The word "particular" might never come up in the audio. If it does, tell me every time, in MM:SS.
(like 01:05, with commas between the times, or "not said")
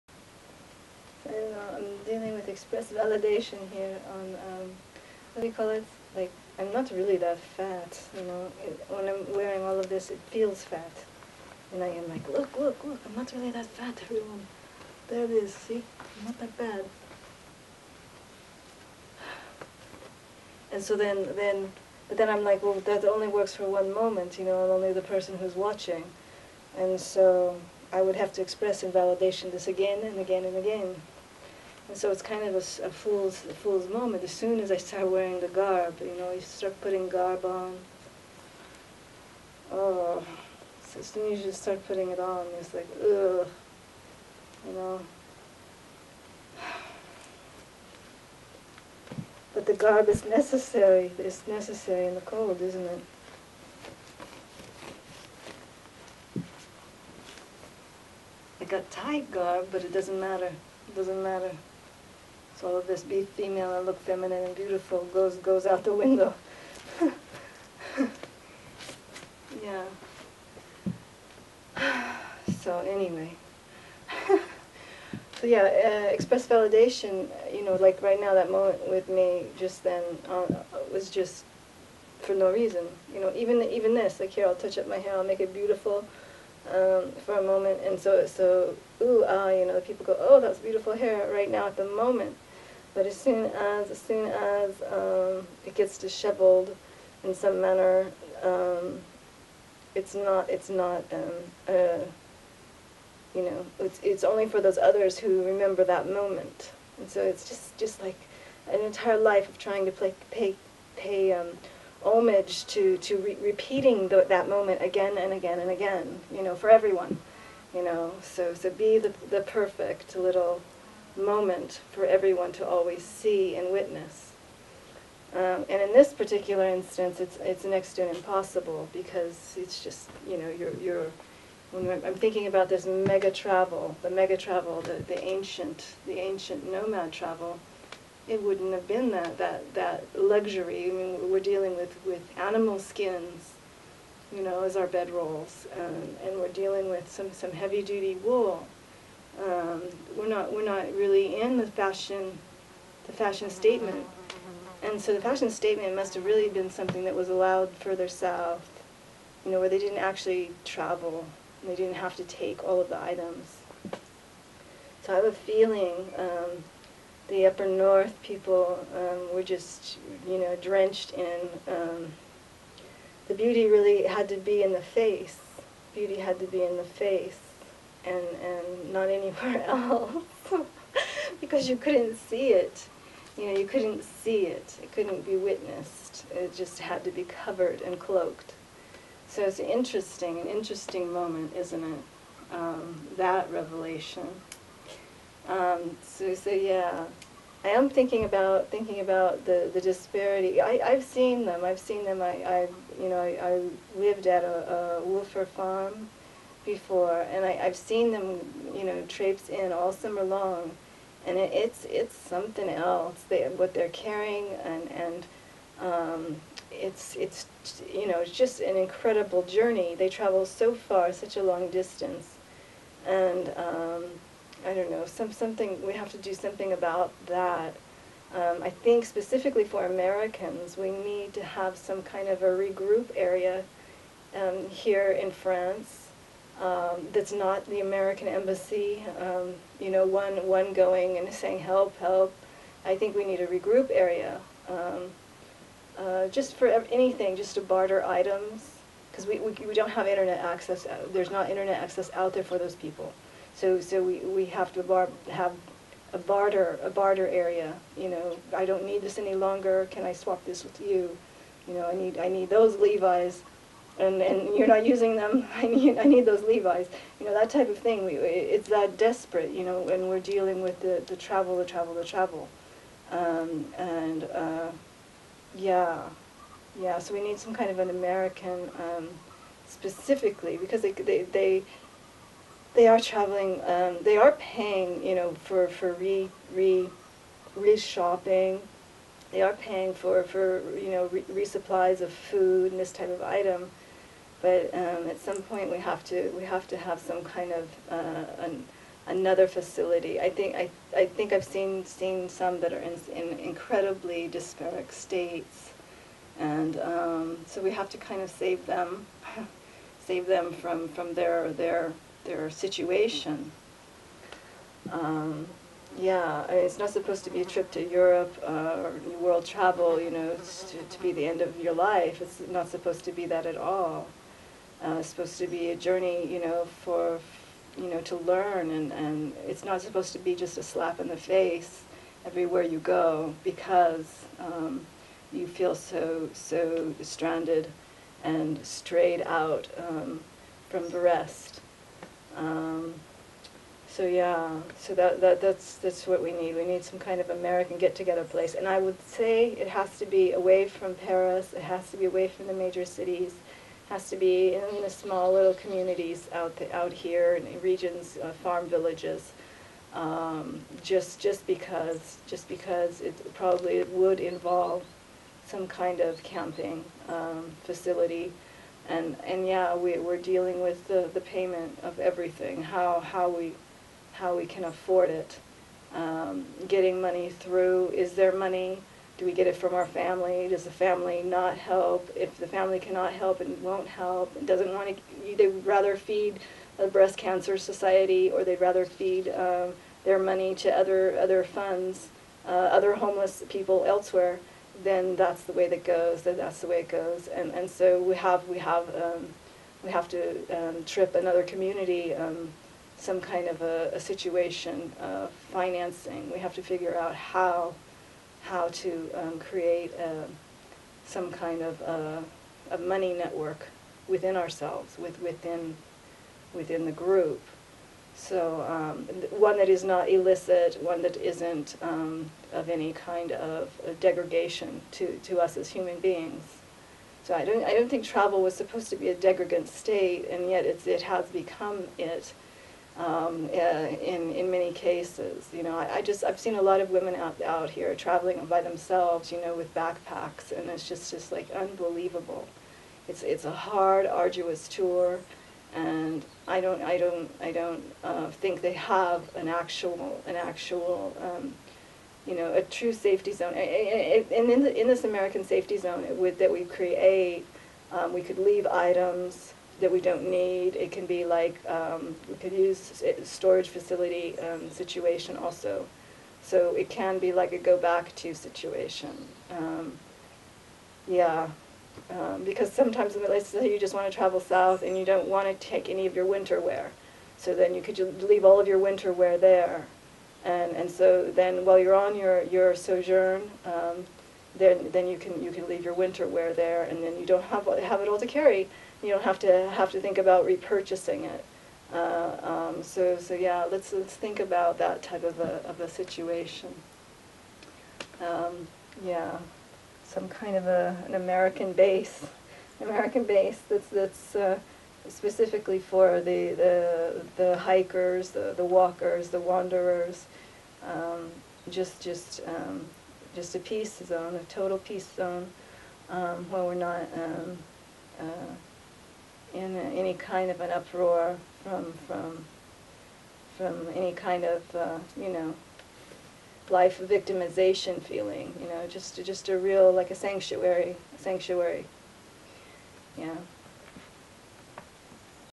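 02:06.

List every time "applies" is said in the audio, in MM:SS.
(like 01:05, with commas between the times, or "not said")
not said.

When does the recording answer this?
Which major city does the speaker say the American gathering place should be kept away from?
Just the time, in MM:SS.
05:50.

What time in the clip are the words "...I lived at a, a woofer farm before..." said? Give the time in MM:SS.
03:23.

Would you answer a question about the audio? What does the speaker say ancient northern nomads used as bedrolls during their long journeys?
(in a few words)
Animal skins.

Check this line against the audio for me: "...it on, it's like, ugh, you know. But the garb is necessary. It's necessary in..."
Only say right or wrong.
right.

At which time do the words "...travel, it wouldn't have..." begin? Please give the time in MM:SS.
02:17.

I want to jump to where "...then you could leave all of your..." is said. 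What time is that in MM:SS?
07:57.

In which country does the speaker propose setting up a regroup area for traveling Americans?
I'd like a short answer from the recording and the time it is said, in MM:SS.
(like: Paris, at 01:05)
France, at 03:55.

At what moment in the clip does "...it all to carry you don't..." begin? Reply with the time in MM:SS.
08:08.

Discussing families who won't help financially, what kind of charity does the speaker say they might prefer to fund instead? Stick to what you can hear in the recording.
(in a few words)
Breast cancer society.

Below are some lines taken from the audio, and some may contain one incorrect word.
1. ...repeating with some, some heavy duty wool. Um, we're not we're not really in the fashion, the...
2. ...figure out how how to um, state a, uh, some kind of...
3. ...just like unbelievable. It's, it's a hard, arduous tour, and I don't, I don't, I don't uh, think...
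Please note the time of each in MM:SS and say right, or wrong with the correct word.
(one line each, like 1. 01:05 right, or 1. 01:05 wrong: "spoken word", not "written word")
1. 02:26 wrong: "dealing", not "repeating"
2. 06:46 wrong: "create", not "state"
3. 07:21 right.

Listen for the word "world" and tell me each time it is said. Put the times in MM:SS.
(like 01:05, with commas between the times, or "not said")
05:19.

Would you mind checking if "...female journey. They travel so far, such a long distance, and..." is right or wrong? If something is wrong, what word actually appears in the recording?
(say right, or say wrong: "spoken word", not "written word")
wrong: "incredible", not "female".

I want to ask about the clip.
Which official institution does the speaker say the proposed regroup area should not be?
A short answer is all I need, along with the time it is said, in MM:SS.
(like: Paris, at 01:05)
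The American embassy, at 03:57.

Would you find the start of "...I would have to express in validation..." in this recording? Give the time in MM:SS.
00:27.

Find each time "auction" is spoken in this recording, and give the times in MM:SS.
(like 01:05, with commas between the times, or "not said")
not said.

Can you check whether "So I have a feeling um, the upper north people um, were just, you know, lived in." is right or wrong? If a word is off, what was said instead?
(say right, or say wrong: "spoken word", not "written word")
wrong: "drenched", not "lived".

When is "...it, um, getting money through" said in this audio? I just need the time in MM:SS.
06:15.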